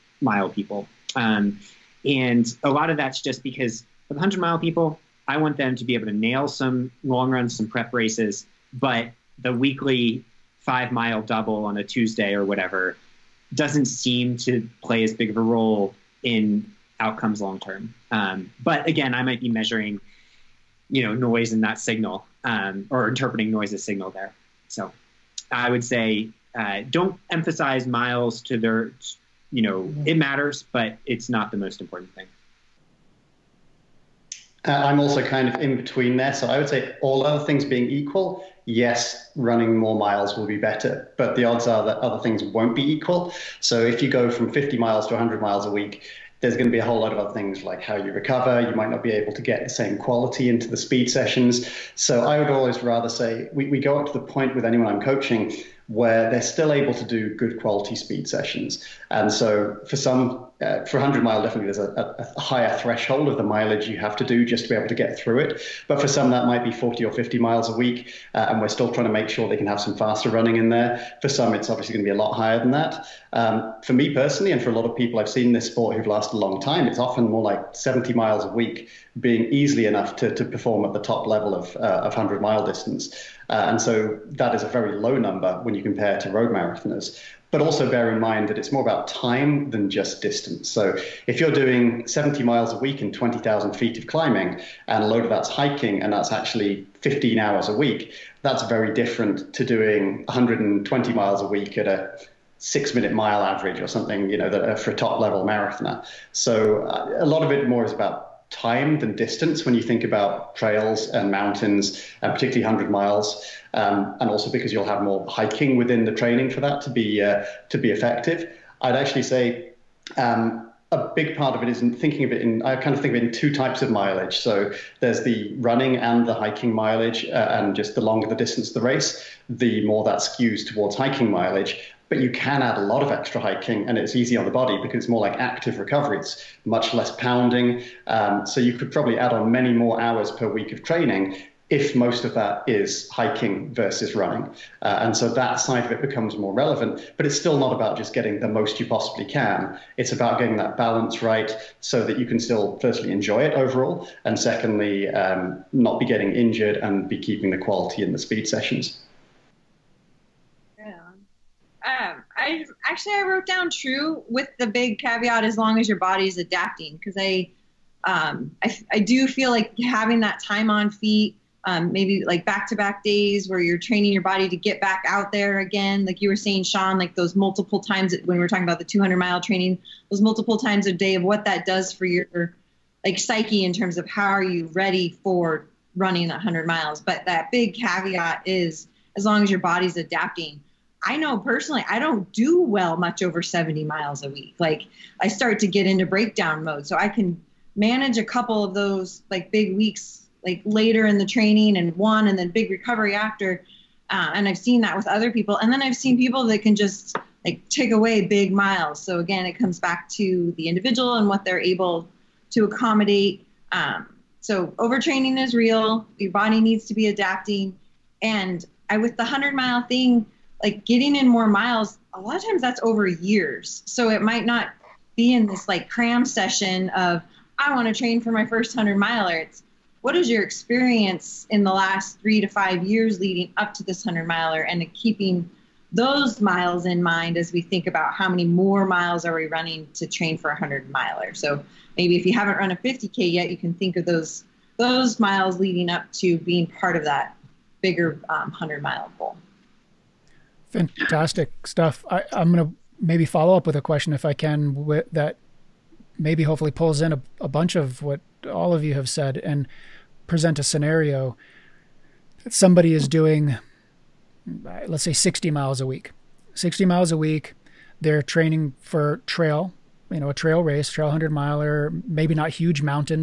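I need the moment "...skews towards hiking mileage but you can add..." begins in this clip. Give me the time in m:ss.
2:10.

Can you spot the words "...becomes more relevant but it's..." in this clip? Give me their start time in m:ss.
2:26.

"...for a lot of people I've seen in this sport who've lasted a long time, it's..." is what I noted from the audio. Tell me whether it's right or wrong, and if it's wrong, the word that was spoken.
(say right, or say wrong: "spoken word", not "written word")
right.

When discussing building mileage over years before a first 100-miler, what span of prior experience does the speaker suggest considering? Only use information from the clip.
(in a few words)
3 to 5 years.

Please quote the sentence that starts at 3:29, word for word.
So again, it comes back to the individual and what they're able to accommodate.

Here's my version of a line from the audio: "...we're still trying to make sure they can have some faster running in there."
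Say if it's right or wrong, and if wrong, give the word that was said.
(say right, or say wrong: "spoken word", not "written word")
right.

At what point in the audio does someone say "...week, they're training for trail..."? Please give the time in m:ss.
4:27.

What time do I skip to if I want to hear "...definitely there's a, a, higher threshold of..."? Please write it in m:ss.
1:01.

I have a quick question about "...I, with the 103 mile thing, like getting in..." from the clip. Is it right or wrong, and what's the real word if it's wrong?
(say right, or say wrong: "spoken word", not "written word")
wrong: "100", not "103".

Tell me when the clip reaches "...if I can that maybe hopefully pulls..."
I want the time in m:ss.
4:14.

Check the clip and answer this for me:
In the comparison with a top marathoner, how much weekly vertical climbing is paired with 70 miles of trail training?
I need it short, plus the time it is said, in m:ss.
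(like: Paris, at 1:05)
20,000 feet, at 1:33.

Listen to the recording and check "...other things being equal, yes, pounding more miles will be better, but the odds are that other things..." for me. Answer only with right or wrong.
wrong.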